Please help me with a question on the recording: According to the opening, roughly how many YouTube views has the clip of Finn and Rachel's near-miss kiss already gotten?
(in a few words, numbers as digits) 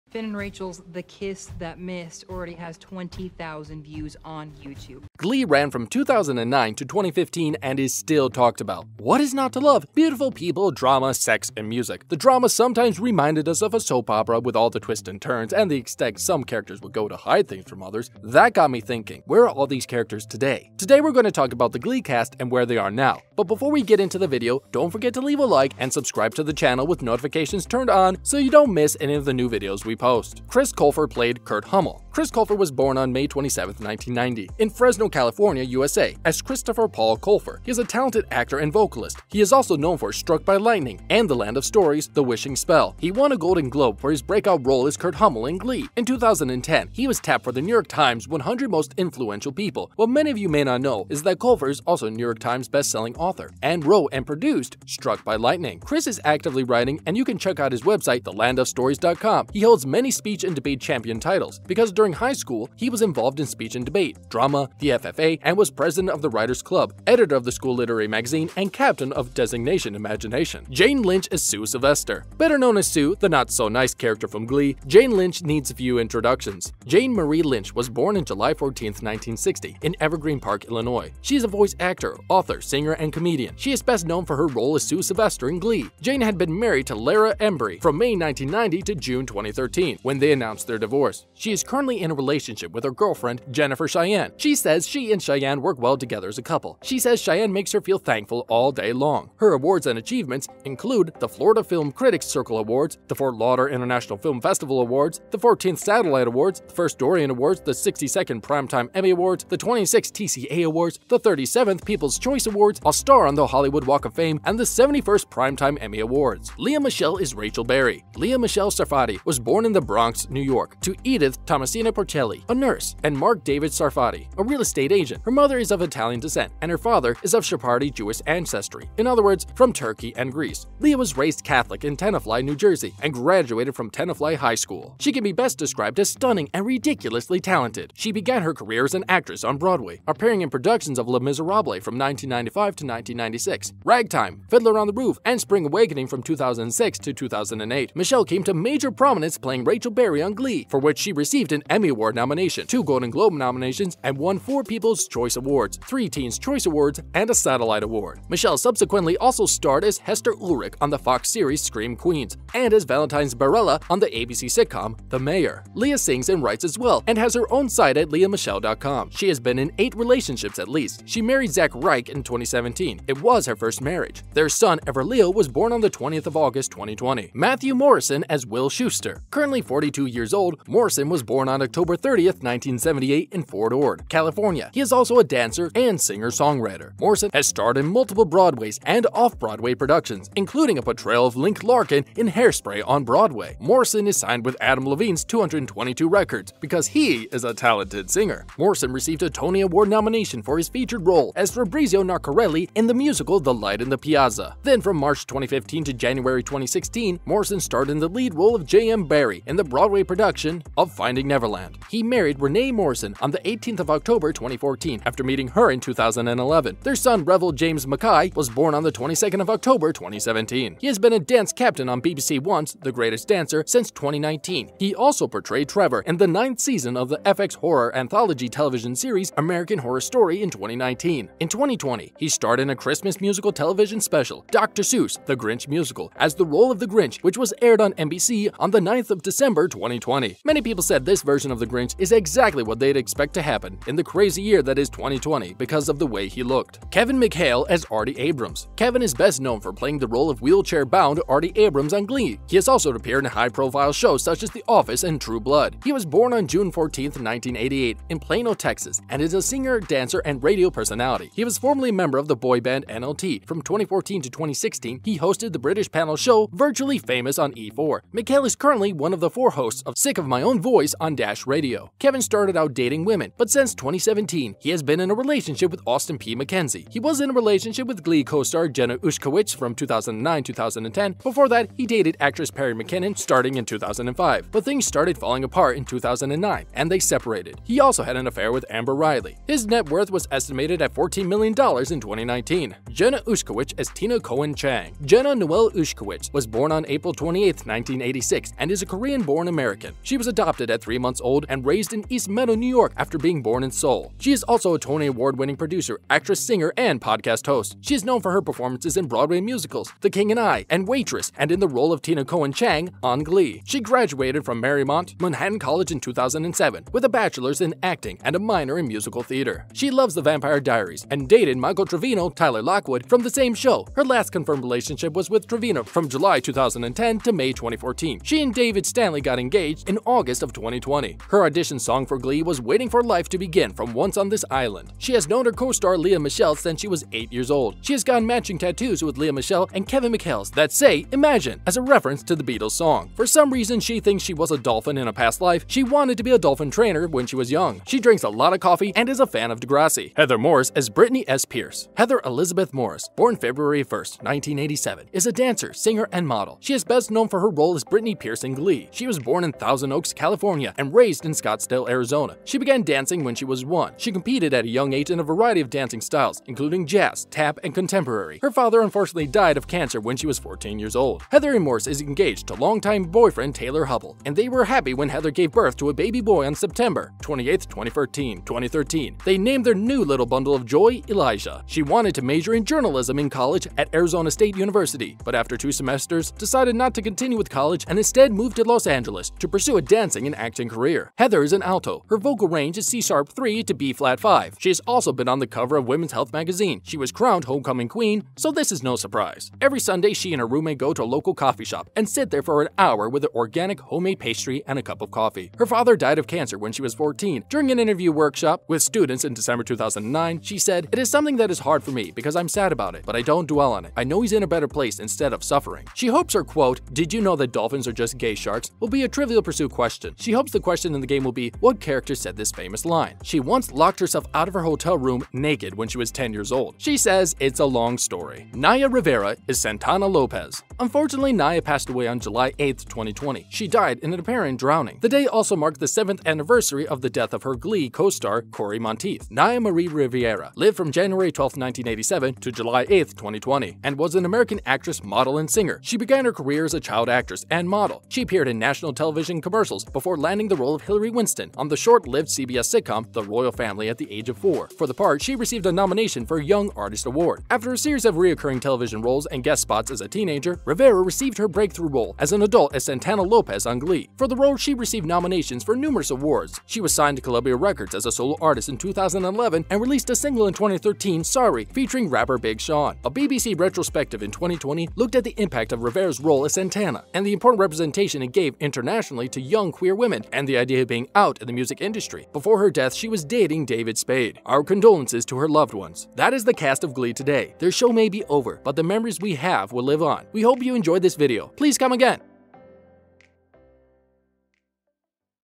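20,000.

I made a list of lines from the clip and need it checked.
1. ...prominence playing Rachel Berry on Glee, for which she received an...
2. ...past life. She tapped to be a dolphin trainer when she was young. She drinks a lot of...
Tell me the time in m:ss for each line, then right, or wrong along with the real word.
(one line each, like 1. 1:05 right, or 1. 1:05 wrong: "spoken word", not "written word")
1. 2:28 right
2. 5:45 wrong: "wanted", not "tapped".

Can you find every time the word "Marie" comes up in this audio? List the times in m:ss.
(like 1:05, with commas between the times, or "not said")
1:17, 7:19.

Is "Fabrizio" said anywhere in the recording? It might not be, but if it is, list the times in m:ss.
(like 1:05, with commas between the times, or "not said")
3:21.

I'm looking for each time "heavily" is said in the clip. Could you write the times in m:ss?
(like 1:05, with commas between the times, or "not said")
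not said.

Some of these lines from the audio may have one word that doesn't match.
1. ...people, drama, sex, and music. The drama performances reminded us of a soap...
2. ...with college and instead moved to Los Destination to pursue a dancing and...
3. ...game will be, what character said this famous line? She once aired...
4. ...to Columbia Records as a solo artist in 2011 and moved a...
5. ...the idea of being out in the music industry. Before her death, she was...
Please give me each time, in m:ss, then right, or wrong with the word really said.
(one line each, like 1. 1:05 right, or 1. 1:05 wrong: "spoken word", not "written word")
1. 0:10 wrong: "sometimes", not "performances"
2. 6:27 wrong: "Angeles", not "Destination"
3. 7:01 wrong: "locked", not "aired"
4. 7:47 wrong: "released", not "moved"
5. 8:00 right.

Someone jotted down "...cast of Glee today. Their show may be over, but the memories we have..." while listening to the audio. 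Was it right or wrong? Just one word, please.
right.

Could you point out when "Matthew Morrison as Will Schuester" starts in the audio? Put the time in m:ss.
2:57.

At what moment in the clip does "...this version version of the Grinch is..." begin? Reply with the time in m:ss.
4:01.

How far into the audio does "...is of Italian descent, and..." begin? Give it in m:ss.
2:05.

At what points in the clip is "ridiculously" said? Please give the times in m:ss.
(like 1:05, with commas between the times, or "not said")
2:16.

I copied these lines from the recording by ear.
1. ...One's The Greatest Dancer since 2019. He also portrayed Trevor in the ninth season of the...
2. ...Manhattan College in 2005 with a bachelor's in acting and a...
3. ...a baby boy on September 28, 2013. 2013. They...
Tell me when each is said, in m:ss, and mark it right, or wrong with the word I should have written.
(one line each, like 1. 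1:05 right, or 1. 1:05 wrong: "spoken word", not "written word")
1. 3:42 right
2. 5:15 wrong: "2007", not "2005"
3. 6:15 right.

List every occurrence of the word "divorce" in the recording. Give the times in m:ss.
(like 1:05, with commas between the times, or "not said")
1:30.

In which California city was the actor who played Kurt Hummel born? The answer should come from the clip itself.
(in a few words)
Fresno.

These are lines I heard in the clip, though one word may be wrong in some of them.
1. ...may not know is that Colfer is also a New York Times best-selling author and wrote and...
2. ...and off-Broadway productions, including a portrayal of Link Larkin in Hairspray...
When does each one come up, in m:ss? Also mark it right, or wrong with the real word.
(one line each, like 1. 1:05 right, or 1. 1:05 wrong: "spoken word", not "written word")
1. 0:50 right
2. 3:08 right.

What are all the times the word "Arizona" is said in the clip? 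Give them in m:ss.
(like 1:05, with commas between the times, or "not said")
6:01, 6:23.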